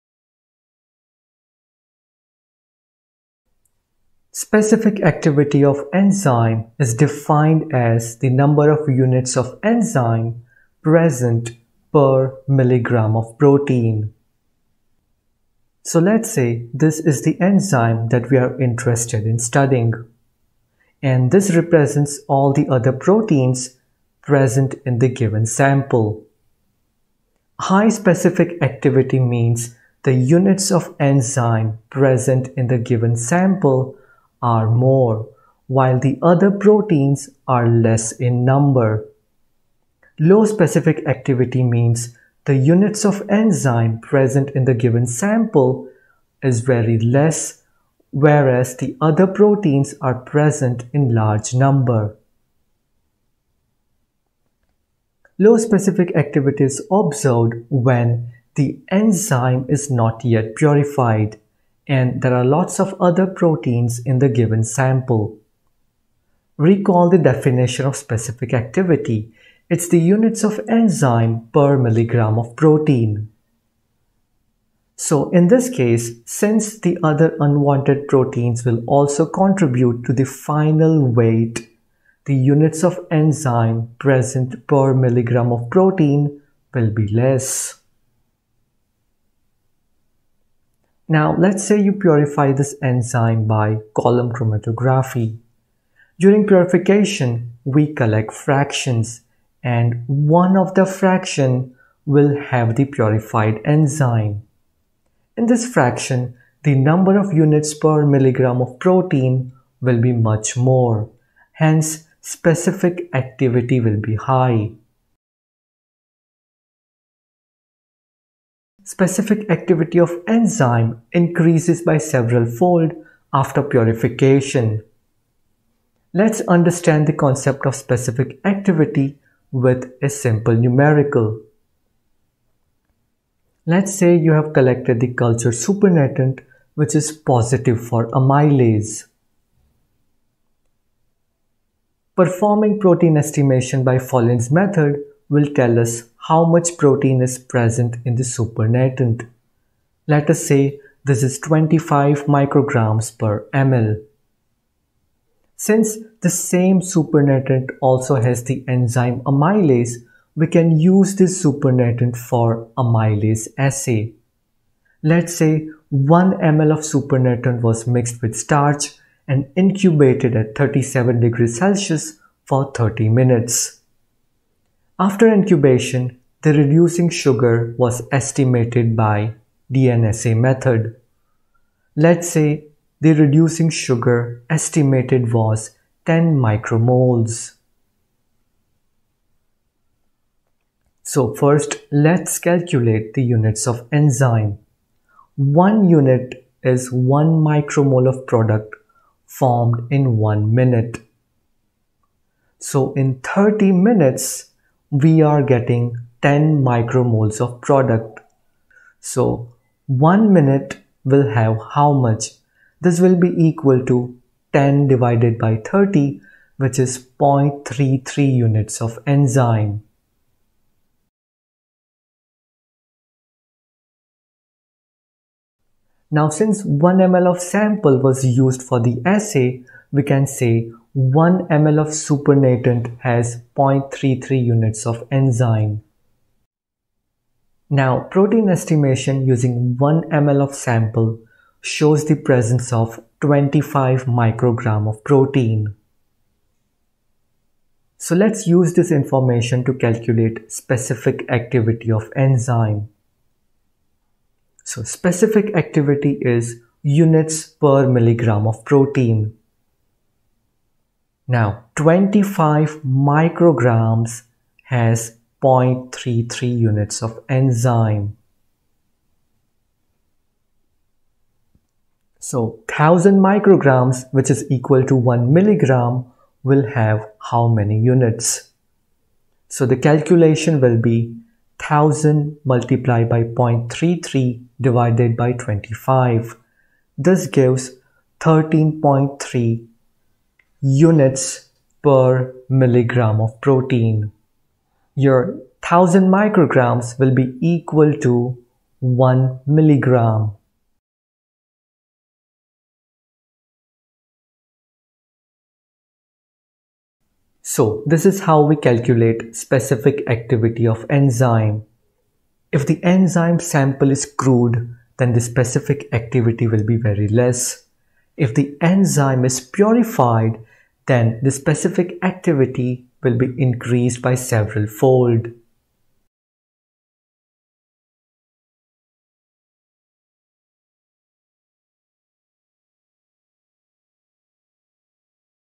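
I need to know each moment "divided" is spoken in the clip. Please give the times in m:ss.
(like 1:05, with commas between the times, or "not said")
3:34, 4:44.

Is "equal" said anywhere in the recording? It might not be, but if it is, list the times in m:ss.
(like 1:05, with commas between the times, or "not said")
3:33, 4:34, 4:57.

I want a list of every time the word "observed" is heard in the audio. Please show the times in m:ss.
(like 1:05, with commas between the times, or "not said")
0:56.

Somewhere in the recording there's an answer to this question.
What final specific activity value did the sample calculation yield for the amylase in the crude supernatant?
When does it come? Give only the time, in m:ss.
4:48.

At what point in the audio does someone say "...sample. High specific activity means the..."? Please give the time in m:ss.
0:25.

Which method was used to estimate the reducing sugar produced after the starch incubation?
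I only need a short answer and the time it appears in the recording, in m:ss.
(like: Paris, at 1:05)
DNSA method, at 2:59.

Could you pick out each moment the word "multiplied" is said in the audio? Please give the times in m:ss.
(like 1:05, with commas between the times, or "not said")
4:42.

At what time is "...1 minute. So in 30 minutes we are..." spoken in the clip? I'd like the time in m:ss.
3:20.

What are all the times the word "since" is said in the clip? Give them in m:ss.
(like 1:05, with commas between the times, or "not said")
1:16, 2:35, 3:46.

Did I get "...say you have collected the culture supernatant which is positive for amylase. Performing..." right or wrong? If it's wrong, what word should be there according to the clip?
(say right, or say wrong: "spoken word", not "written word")
right.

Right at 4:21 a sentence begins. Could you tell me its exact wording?
Now 25 micrograms has 0.33 units of enzyme.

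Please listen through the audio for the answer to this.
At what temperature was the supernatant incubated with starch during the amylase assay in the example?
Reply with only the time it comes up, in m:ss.
2:50.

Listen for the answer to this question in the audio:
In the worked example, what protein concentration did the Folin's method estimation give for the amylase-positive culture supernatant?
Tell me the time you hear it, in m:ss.
2:31.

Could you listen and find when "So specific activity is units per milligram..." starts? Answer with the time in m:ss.
4:14.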